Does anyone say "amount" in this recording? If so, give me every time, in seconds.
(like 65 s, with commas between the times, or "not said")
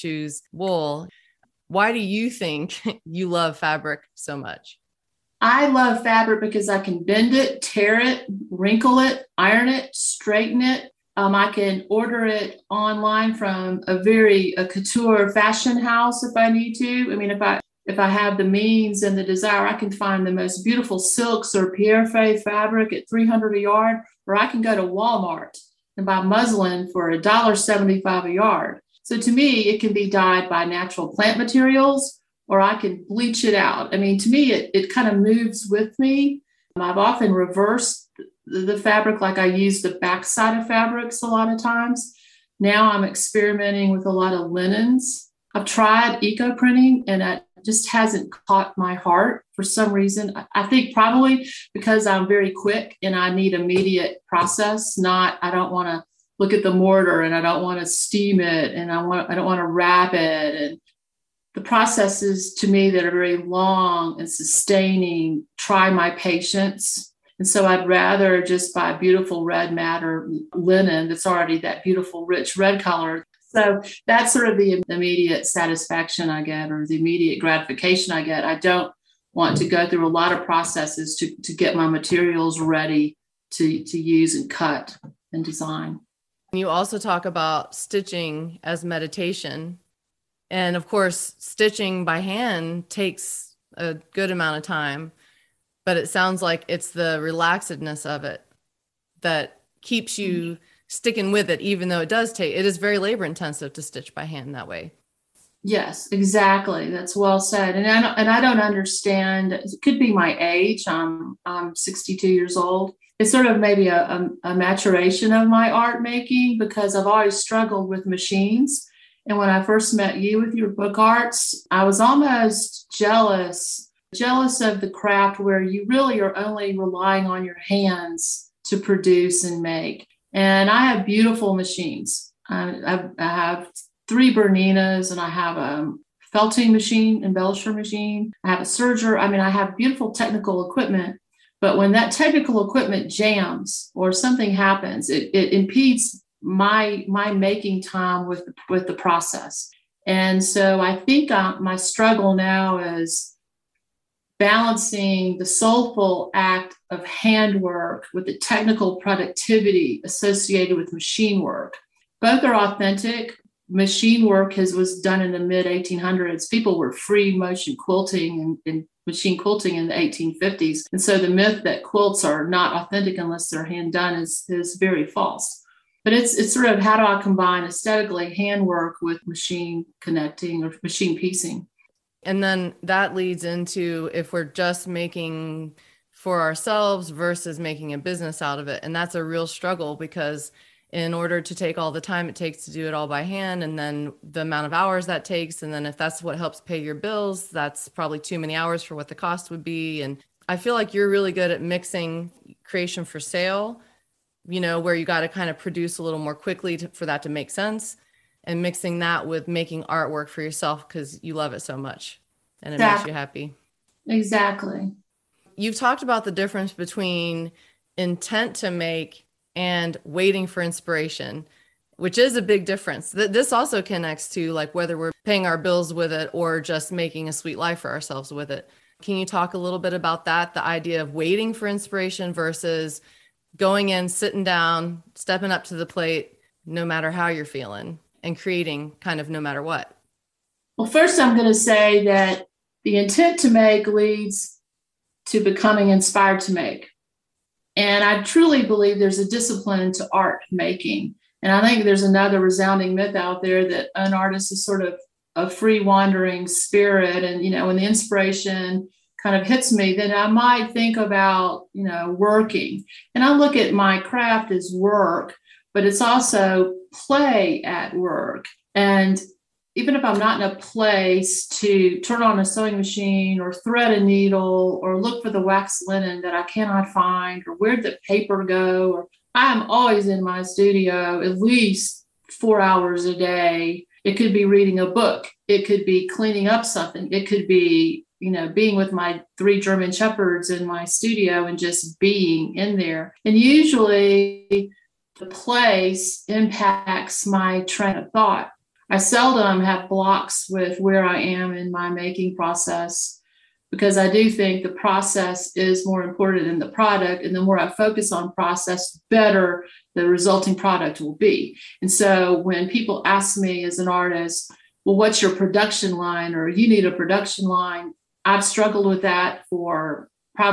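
94 s, 194 s.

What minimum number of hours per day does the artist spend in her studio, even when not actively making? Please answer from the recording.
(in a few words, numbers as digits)
4.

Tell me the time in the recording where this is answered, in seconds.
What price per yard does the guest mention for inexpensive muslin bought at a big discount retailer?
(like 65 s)
27 s.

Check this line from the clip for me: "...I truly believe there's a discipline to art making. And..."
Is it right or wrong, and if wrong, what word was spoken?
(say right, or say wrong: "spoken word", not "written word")
right.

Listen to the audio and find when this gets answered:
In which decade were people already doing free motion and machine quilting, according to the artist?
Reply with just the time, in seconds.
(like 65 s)
169 s.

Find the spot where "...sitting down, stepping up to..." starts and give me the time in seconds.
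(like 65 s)
234 s.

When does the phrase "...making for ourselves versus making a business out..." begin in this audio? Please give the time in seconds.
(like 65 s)
184 s.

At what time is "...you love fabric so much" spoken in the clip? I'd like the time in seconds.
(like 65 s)
3 s.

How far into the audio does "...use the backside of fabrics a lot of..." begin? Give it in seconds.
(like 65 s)
39 s.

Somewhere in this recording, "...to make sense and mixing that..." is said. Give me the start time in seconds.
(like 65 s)
207 s.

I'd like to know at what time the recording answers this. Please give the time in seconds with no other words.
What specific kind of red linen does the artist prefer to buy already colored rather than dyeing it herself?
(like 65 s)
69 s.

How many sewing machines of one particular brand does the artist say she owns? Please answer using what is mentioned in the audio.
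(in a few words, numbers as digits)
3.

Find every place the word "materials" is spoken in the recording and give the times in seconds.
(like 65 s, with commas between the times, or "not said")
31 s, 81 s.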